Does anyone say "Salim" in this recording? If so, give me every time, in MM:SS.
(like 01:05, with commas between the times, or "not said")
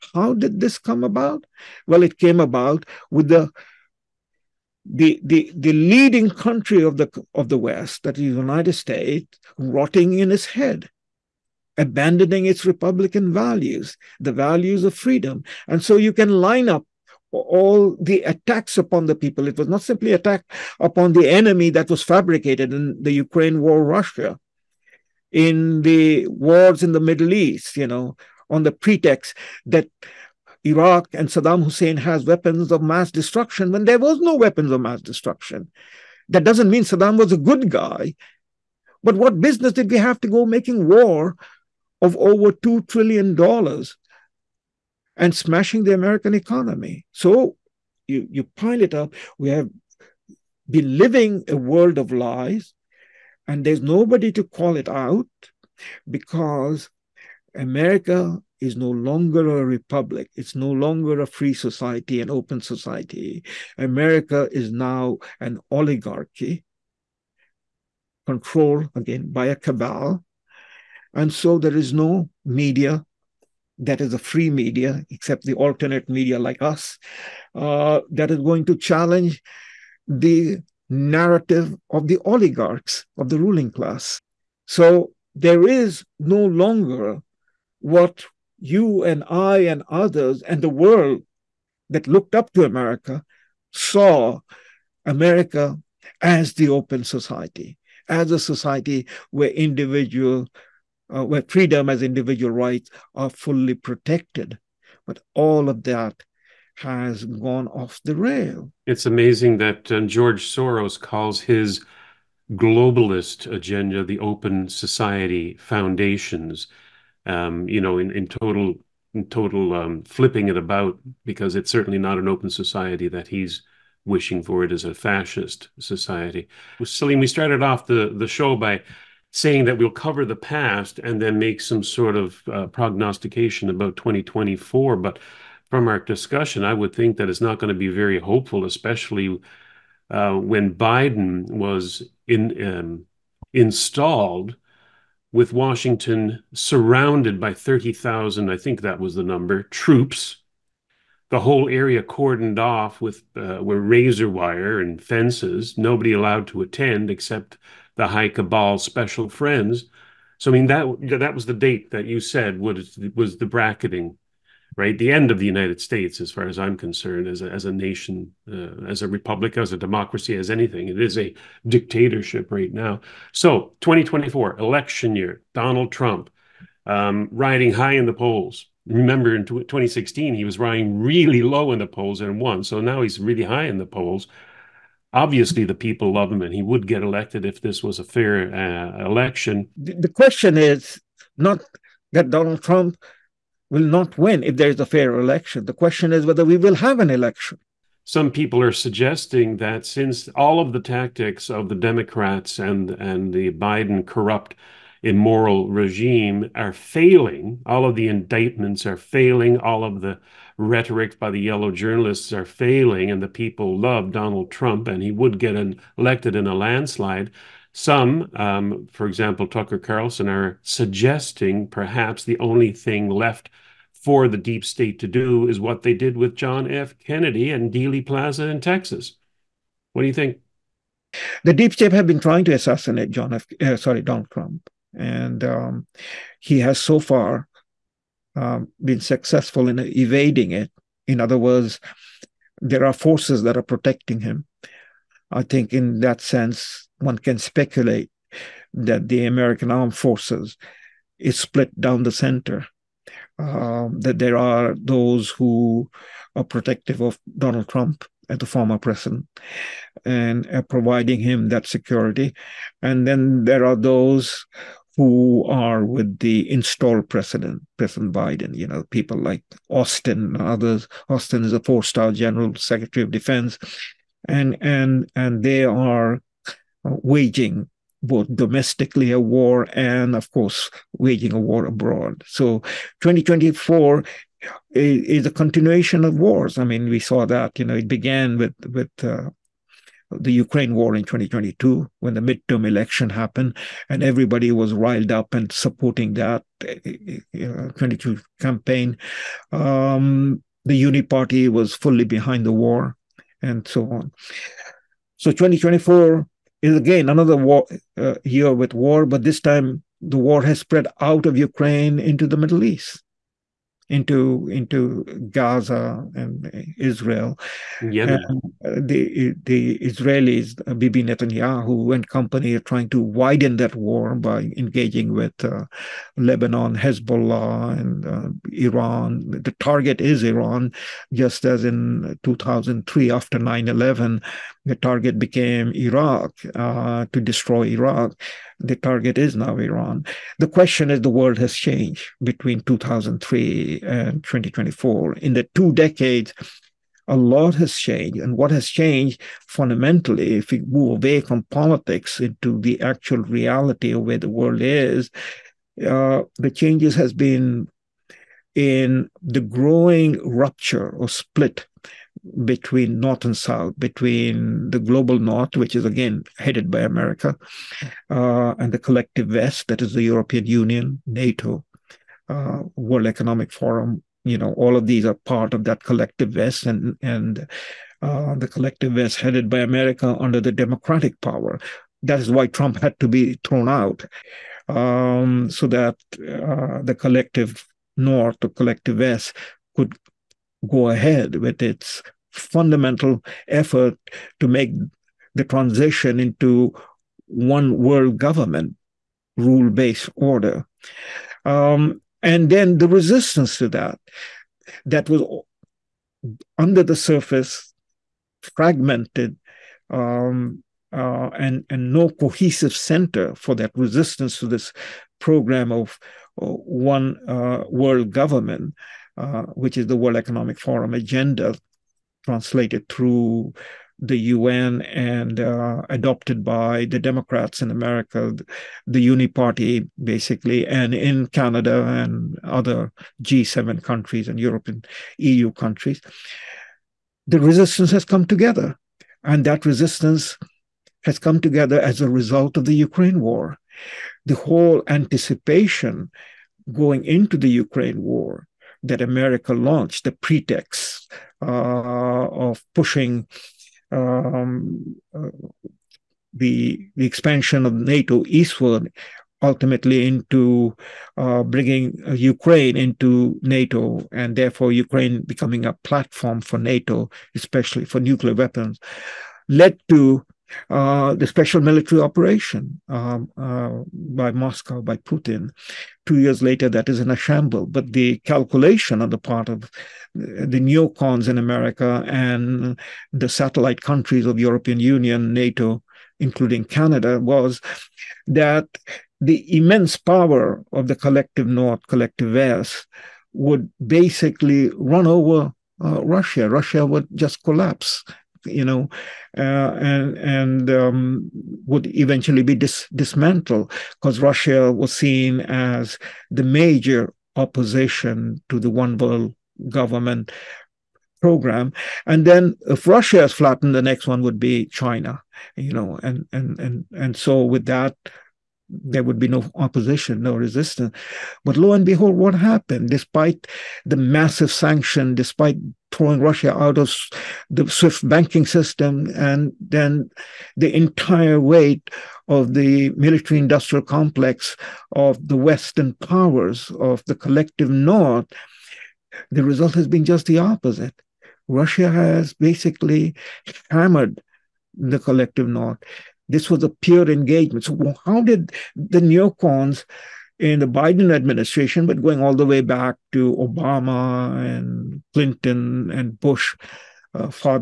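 02:06.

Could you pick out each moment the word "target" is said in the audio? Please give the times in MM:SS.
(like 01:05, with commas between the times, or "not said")
05:29, 05:34, 05:38.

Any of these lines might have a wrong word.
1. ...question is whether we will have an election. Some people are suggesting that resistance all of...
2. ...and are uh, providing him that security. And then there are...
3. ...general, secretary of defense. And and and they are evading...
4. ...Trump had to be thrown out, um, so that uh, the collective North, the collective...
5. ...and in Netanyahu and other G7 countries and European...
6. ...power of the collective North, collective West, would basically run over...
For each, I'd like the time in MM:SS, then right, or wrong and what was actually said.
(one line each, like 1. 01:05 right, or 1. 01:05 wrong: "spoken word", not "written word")
1. 03:15 wrong: "since", not "resistance"
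2. 04:20 right
3. 04:32 wrong: "waging", not "evading"
4. 06:22 right
5. 07:10 wrong: "Canada", not "Netanyahu"
6. 08:09 right.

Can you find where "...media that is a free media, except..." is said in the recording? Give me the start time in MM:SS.
01:12.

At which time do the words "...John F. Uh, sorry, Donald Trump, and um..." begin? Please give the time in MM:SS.
03:53.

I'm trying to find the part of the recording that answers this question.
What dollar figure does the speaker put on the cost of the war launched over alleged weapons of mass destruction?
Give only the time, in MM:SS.
00:42.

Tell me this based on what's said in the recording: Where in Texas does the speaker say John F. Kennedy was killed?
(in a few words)
Dealey Plaza.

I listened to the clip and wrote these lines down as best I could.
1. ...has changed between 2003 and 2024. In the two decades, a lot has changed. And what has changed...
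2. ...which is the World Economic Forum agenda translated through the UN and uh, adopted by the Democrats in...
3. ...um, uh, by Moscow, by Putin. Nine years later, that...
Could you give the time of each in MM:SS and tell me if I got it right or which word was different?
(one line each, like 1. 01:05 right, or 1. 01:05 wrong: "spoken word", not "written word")
1. 05:41 right
2. 06:59 right
3. 07:52 wrong: "Two", not "Nine".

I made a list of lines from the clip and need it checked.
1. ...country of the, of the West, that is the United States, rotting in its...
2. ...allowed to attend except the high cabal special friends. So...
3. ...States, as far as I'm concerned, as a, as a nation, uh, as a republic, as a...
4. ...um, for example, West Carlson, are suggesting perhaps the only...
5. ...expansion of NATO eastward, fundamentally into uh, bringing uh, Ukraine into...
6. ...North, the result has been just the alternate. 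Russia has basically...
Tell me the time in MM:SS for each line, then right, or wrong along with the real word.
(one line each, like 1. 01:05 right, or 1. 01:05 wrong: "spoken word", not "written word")
1. 00:06 right
2. 02:36 right
3. 02:45 right
4. 03:38 wrong: "Tucker", not "West"
5. 07:37 wrong: "ultimately", not "fundamentally"
6. 08:57 wrong: "opposite", not "alternate".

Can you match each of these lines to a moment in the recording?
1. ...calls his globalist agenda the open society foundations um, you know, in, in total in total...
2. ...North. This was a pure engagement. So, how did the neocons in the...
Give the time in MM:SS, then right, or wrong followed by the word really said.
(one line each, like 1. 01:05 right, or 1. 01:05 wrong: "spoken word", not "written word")
1. 01:50 right
2. 09:05 right.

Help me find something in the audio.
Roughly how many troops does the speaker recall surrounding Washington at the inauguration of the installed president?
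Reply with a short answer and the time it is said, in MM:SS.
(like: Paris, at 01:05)
30,000, at 02:27.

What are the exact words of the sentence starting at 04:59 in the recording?
Um, the Uni Party was fully behind the war, and so on.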